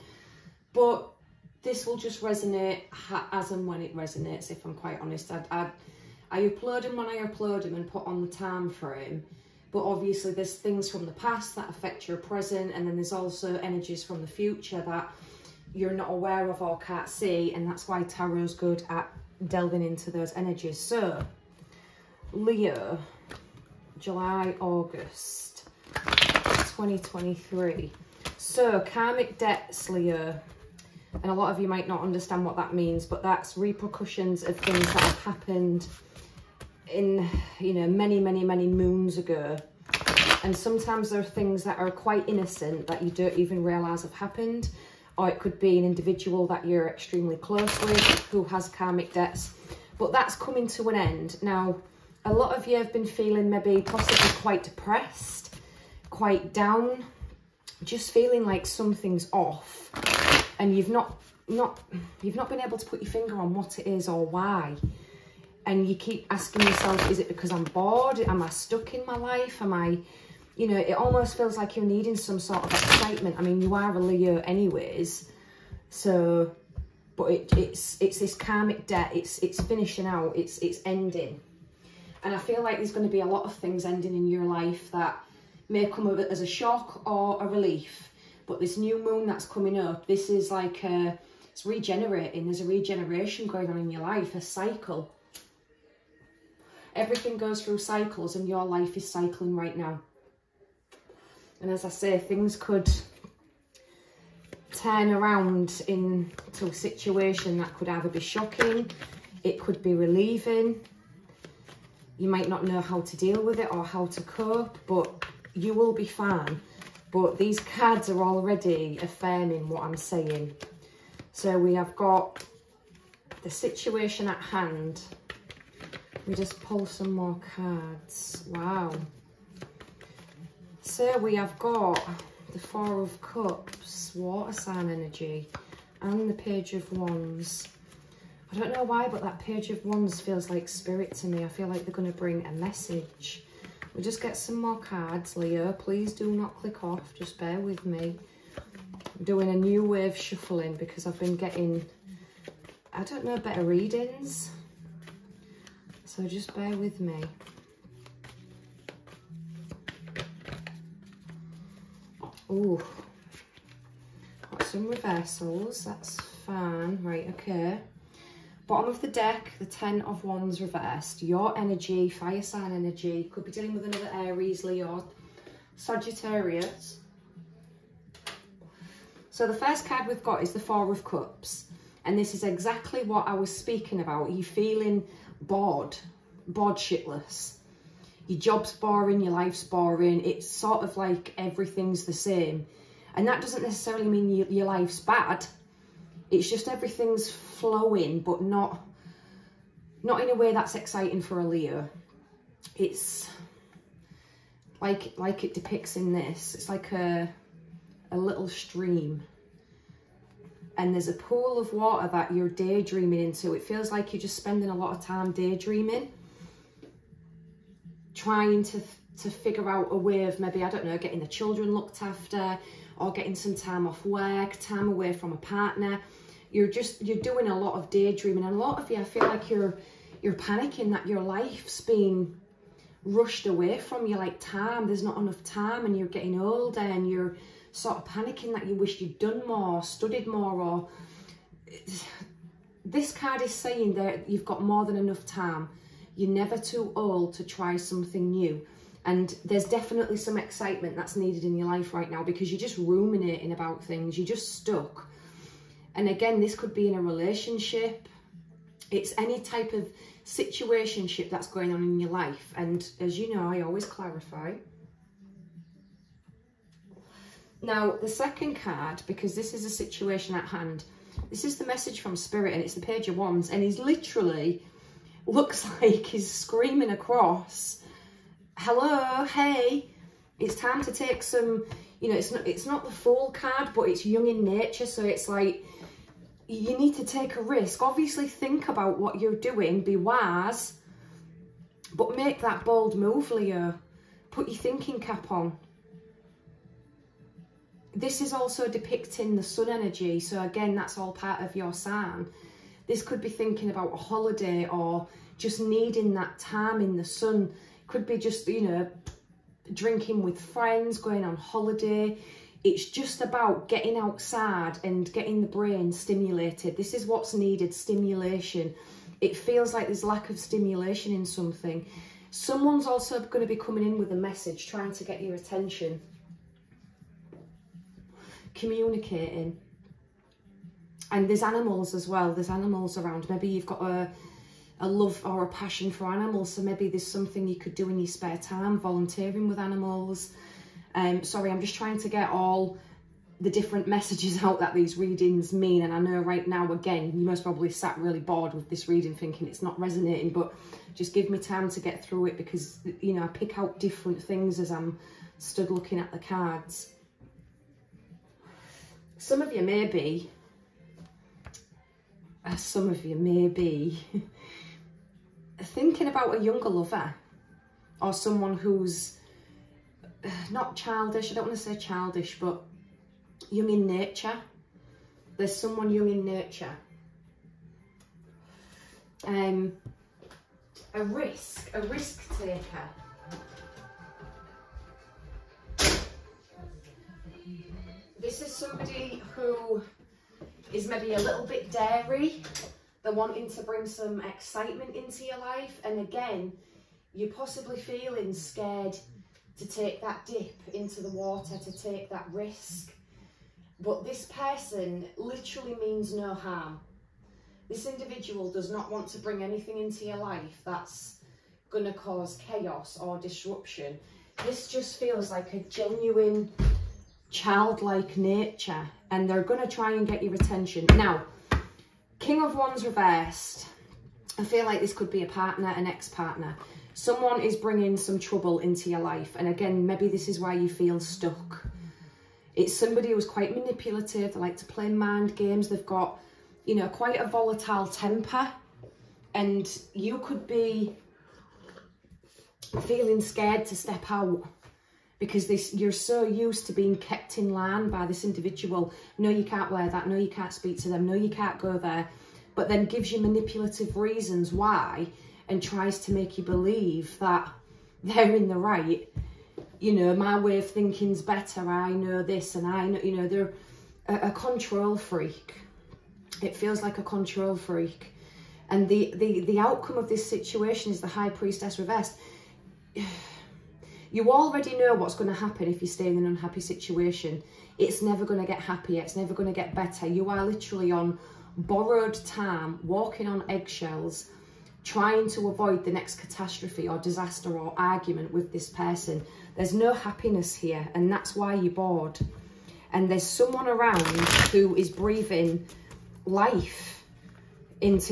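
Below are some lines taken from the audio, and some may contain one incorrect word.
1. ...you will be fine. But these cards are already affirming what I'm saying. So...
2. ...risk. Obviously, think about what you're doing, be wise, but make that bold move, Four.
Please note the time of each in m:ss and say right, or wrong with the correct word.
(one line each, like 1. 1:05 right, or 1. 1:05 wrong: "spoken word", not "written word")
1. 1:55 right
2. 4:47 wrong: "Leo", not "Four".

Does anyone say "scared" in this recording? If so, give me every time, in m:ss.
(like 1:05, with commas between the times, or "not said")
6:38, 7:23.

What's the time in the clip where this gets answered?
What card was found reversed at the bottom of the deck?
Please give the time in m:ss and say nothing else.
2:49.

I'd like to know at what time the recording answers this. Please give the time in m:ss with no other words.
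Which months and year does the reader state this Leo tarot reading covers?
0:23.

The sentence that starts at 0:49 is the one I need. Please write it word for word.
But that's coming to an end.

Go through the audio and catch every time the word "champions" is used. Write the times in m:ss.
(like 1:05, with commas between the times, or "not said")
not said.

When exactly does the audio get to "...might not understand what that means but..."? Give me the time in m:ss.
0:31.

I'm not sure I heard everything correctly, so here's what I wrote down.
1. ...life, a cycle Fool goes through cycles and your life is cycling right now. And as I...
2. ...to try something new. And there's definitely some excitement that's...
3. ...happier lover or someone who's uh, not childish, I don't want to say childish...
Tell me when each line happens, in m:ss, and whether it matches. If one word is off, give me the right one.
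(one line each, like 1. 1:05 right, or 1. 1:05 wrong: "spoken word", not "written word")
1. 1:34 wrong: "Everything", not "Fool"
2. 4:07 right
3. 6:06 wrong: "younger", not "happier".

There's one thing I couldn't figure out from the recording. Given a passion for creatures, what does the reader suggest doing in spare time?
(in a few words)
Volunteering with animals.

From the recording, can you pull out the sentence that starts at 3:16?
It's just everything's flowing, but not not in a way that's exciting for a Leo.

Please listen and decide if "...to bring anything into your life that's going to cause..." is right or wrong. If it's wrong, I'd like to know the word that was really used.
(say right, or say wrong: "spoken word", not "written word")
right.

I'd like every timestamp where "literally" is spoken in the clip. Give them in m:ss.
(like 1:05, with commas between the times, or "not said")
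4:33, 6:45, 8:00.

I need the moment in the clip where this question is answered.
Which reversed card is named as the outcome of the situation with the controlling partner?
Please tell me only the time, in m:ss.
7:51.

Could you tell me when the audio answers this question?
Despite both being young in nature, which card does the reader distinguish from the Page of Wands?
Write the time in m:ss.
4:42.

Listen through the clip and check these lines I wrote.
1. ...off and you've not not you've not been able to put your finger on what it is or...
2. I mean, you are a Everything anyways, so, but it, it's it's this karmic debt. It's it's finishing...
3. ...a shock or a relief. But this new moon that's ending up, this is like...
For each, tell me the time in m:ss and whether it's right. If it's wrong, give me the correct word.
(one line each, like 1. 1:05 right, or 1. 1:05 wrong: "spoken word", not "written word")
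1. 0:59 right
2. 1:13 wrong: "Leo", not "Everything"
3. 1:26 wrong: "coming", not "ending".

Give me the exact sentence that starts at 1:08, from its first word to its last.
Am I stuck in my life?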